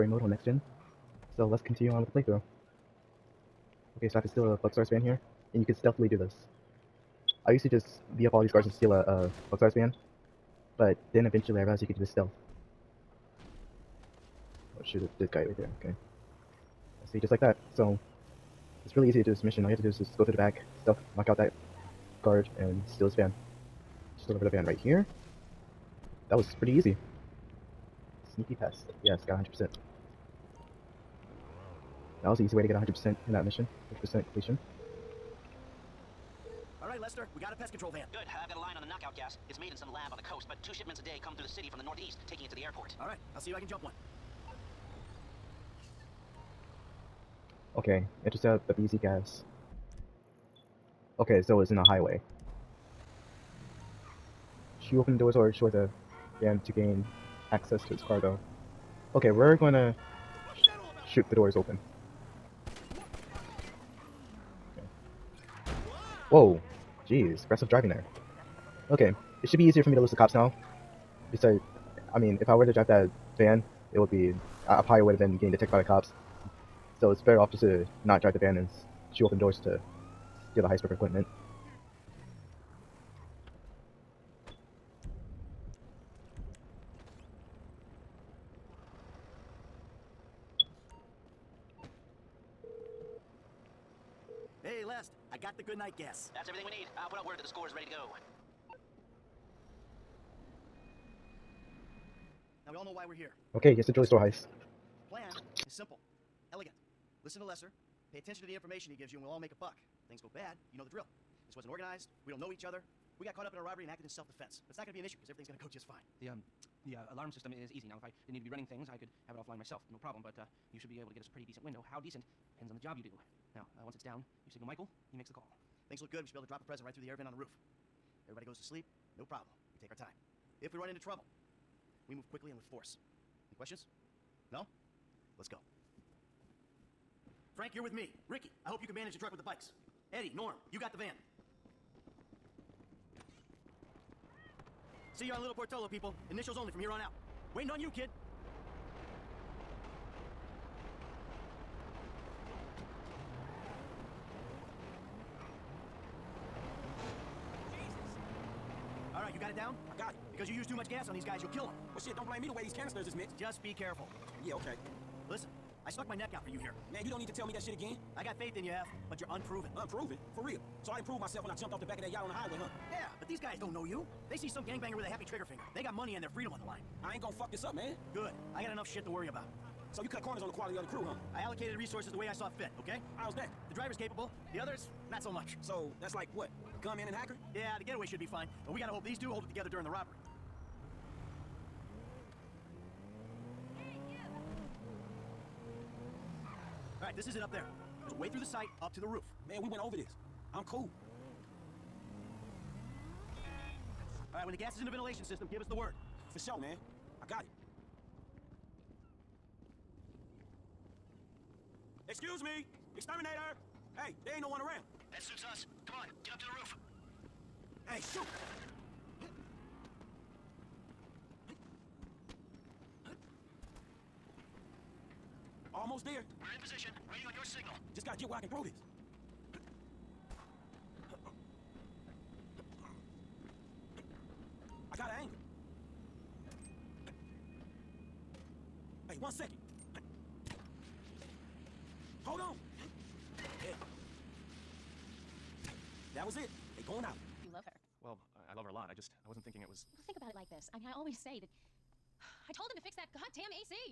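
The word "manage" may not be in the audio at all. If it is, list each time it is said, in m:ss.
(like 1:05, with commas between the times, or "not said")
2:18.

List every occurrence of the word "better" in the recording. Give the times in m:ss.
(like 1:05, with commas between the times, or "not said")
1:17.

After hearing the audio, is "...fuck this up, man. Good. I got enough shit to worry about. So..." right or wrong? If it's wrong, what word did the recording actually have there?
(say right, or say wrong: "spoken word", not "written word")
right.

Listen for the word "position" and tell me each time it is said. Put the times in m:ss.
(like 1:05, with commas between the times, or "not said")
3:46.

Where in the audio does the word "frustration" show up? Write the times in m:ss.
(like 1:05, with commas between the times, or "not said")
not said.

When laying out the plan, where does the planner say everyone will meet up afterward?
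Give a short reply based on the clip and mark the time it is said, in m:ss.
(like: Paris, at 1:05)
Little Portola, at 2:25.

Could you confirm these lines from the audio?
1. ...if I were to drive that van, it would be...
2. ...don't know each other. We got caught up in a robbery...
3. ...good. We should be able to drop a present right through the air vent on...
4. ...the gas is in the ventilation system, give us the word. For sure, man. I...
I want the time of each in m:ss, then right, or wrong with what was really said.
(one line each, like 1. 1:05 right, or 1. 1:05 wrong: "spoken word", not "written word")
1. 1:12 right
2. 1:52 right
3. 2:06 right
4. 3:24 right.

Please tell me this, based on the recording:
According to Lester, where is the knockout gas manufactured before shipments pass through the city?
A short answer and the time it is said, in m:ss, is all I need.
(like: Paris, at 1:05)
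some lab on the coast, at 0:39.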